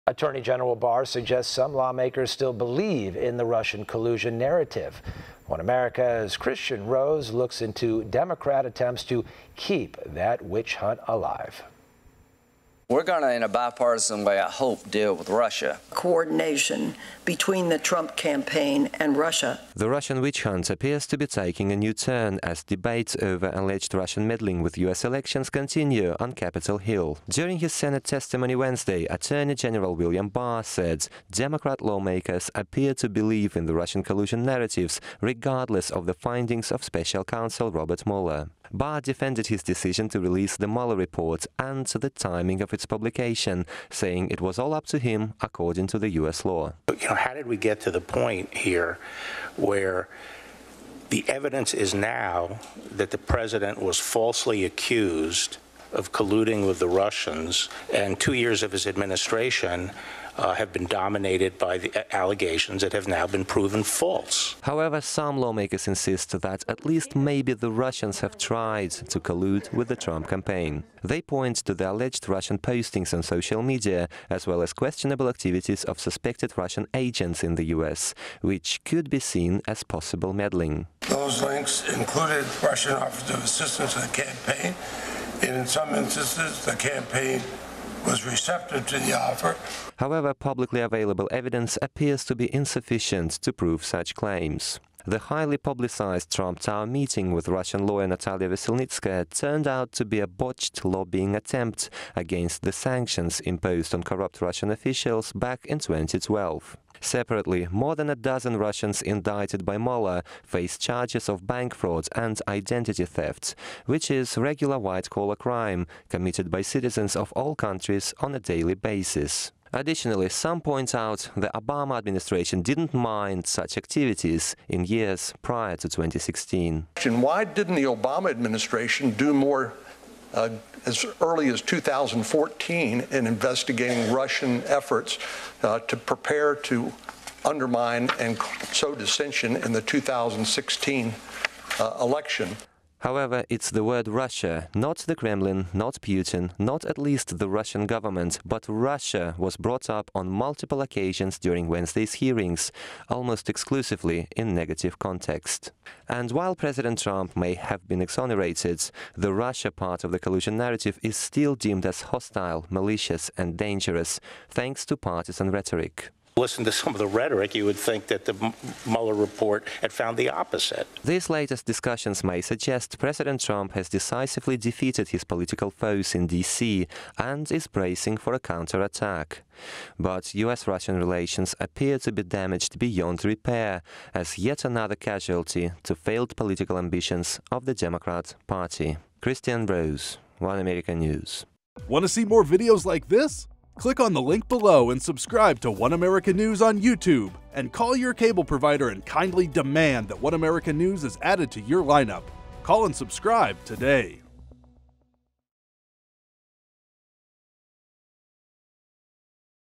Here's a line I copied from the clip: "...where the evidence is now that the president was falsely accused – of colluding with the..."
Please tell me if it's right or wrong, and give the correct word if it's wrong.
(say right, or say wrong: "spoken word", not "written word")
right.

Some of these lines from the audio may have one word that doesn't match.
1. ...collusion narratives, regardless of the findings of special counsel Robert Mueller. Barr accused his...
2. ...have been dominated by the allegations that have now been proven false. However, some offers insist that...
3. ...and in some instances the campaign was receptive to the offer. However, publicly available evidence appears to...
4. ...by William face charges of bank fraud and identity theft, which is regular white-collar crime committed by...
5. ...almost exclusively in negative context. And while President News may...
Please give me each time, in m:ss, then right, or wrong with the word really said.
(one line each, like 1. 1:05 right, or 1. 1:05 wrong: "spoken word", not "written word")
1. 0:34 wrong: "defended", not "accused"
2. 1:00 wrong: "lawmakers", not "offers"
3. 1:25 right
4. 1:49 wrong: "Mueller", not "William"
5. 2:33 wrong: "Trump", not "News".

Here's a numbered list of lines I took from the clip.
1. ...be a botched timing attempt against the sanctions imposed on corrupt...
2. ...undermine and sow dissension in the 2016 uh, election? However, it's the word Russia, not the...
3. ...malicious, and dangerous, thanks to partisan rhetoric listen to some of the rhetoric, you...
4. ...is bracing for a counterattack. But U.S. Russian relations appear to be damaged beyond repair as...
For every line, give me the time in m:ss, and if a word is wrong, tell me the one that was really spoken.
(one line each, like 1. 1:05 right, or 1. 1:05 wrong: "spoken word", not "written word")
1. 1:40 wrong: "lobbying", not "timing"
2. 2:17 right
3. 2:42 right
4. 2:57 right.